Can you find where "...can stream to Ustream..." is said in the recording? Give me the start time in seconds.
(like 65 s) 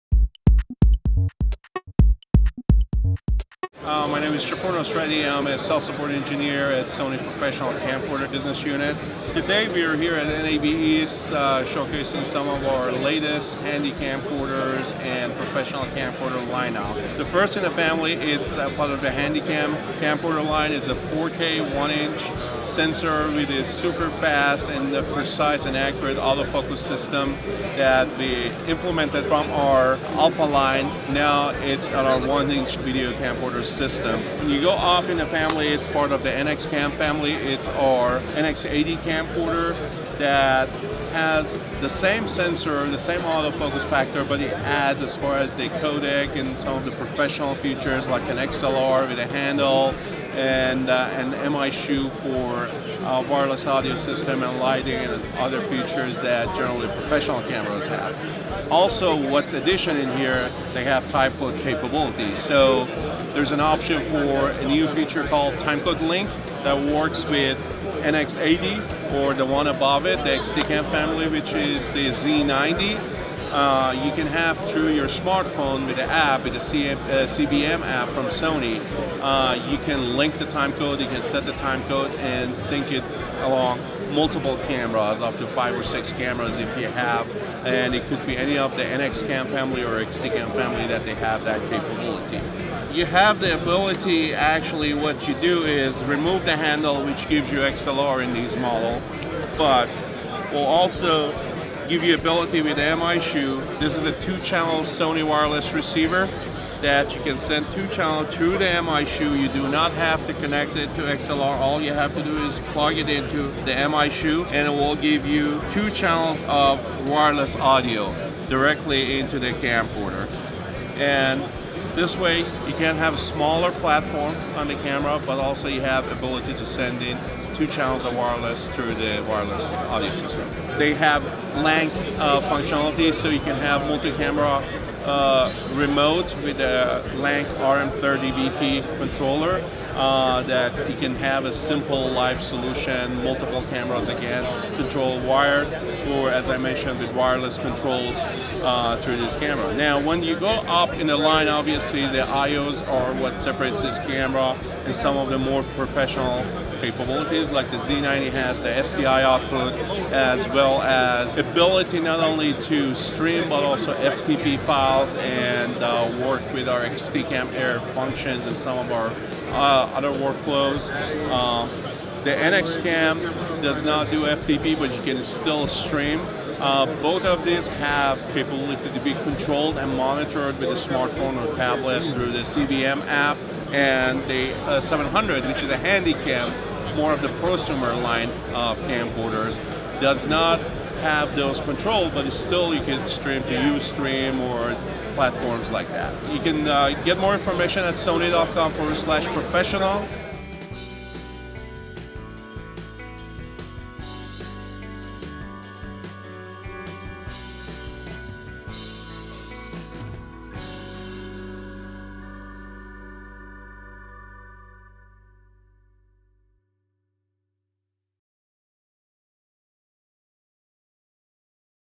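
192 s.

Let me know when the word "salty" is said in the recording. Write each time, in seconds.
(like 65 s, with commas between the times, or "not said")
not said.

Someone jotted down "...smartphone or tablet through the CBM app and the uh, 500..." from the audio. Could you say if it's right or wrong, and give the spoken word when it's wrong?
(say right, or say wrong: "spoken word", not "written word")
wrong: "700", not "500".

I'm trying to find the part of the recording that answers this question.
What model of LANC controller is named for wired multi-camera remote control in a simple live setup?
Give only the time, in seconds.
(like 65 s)
137 s.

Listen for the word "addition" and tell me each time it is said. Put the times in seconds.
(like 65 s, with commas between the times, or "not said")
59 s.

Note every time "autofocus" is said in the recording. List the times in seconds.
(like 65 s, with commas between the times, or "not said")
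26 s, 43 s.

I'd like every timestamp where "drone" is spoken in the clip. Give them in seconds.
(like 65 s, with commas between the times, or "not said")
not said.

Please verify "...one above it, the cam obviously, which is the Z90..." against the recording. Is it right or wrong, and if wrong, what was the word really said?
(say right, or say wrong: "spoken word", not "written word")
wrong: "family", not "obviously".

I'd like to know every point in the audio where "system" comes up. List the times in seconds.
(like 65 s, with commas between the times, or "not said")
26 s, 33 s, 53 s, 130 s.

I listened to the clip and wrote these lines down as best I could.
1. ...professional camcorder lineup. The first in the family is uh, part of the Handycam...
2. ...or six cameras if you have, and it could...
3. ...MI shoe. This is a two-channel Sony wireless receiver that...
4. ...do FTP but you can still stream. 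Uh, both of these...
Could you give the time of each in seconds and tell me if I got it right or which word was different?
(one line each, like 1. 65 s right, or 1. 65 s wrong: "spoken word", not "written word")
1. 15 s right
2. 85 s right
3. 102 s right
4. 174 s right.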